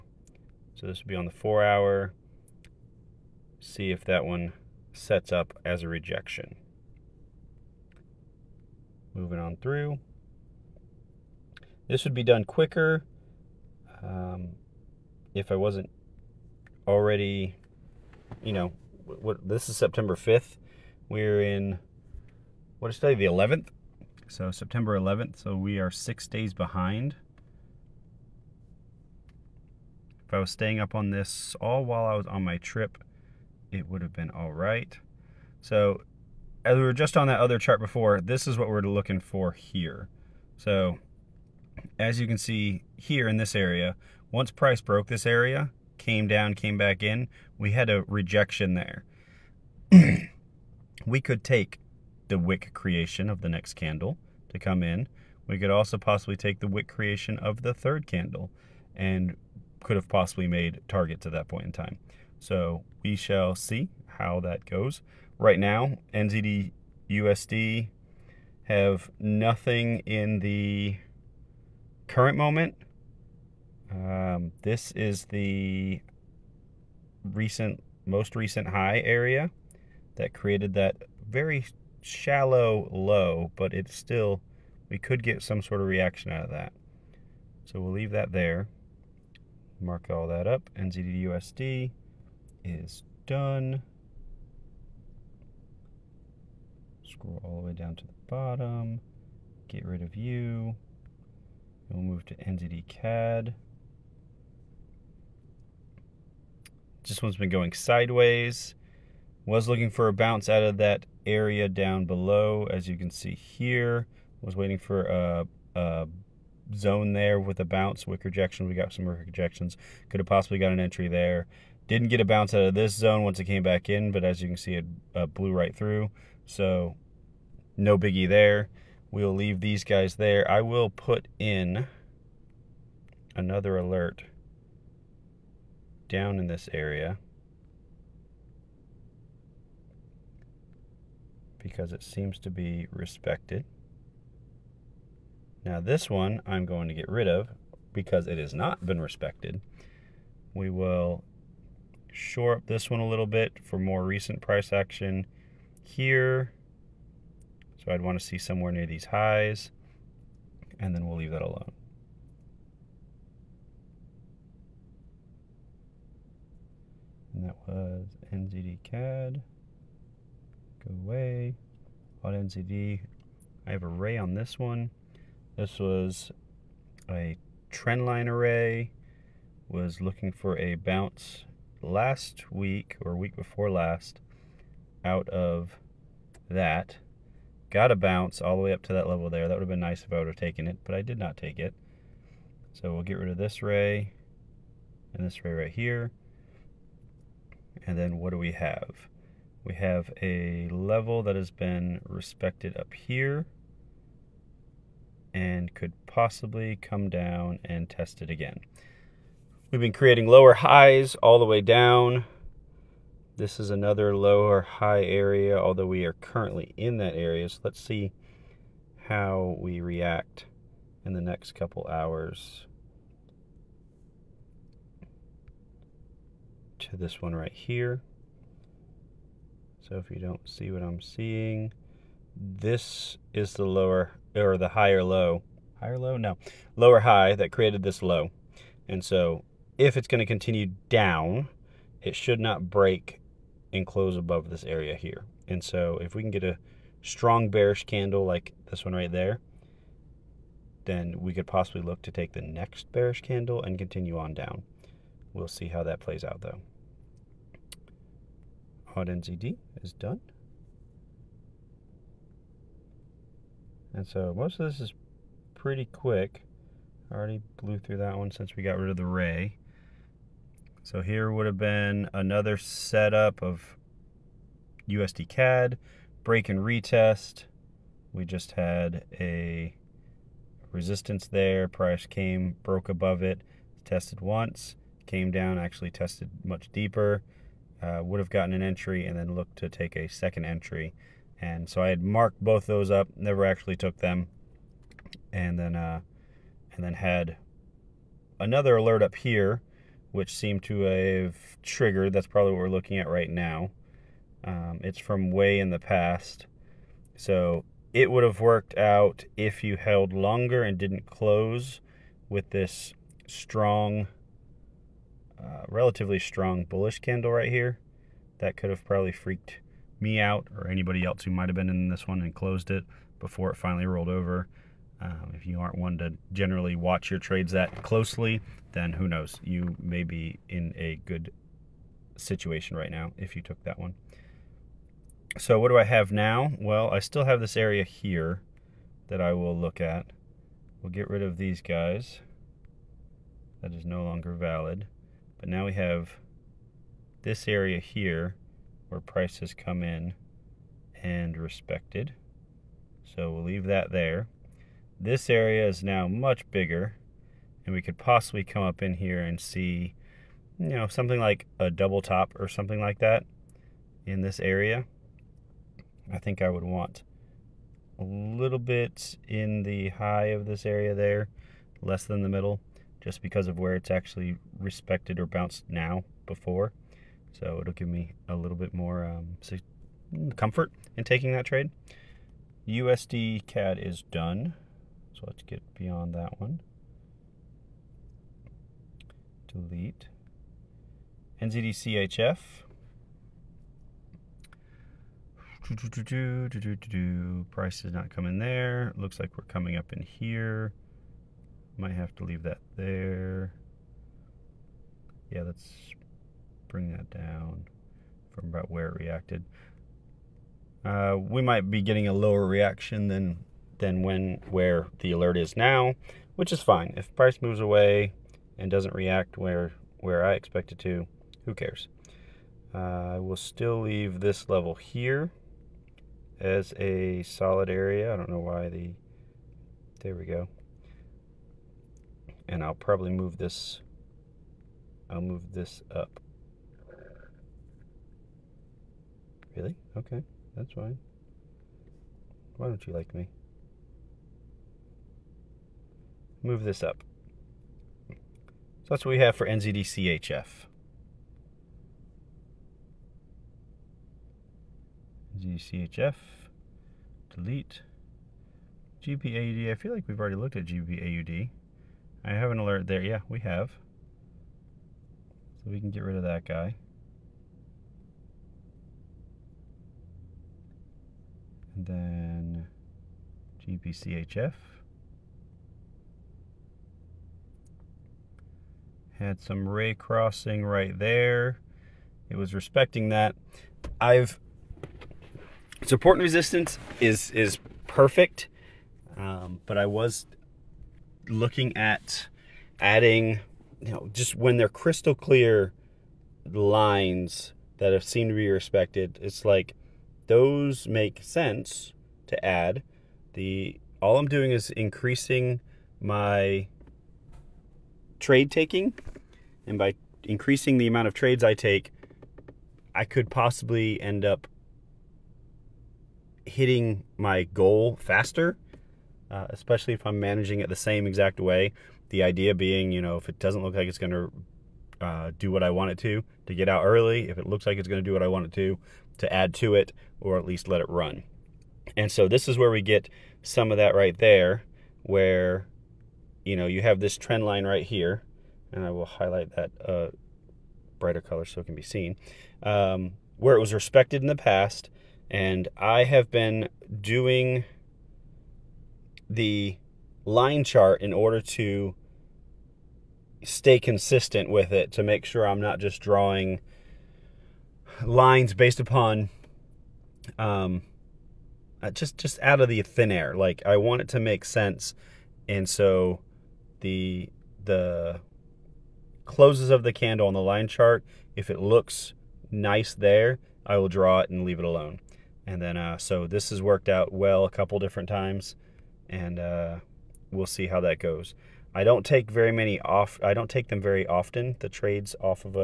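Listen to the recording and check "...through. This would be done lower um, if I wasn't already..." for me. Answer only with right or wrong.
wrong.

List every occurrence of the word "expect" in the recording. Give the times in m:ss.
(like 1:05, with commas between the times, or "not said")
7:00.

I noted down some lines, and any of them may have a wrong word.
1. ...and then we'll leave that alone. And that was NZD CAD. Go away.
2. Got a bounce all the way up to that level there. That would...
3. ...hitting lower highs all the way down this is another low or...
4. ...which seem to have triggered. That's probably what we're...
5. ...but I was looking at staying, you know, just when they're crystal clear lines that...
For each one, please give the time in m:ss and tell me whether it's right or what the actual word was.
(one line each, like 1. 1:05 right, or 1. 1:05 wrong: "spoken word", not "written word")
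1. 2:40 right
2. 3:07 right
3. 3:29 wrong: "creating", not "hitting"
4. 5:00 right
5. 8:09 wrong: "adding", not "staying".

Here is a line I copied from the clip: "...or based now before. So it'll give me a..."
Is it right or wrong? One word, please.
wrong.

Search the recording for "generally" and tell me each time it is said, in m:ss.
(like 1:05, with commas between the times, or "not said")
5:26.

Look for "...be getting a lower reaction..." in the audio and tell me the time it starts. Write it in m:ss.
6:51.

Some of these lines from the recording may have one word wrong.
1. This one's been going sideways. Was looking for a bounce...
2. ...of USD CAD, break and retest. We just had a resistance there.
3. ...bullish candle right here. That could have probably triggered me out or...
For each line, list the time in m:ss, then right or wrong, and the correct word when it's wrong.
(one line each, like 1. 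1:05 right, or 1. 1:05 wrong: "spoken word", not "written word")
1. 1:47 right
2. 4:33 right
3. 5:16 wrong: "freaked", not "triggered".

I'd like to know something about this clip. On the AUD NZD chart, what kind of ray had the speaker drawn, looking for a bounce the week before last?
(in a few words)
Trendline array.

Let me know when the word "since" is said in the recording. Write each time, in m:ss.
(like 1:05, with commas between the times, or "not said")
4:28.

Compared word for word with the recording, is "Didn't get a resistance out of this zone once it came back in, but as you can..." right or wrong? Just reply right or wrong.
wrong.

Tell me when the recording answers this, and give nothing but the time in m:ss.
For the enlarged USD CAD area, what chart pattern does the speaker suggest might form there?
6:01.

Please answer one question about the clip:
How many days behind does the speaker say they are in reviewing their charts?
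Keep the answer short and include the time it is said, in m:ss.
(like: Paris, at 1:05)
6, at 0:25.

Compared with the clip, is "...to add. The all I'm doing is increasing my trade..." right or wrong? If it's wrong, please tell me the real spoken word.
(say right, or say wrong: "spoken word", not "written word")
right.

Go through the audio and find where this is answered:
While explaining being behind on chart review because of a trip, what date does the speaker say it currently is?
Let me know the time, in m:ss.
0:24.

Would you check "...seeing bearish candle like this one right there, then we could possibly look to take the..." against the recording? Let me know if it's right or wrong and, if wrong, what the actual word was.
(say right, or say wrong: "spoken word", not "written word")
wrong: "strong", not "seeing".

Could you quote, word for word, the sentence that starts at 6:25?
So let's get beyond that one.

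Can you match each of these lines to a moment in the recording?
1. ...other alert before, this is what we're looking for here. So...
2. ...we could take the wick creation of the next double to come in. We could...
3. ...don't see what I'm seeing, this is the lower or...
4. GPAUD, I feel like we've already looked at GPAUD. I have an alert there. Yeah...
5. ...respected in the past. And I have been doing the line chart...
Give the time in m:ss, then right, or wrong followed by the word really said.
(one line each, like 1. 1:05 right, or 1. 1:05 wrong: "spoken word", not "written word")
1. 0:37 wrong: "chart", not "alert"
2. 0:51 wrong: "candle", not "double"
3. 3:50 right
4. 7:39 right
5. 9:03 right.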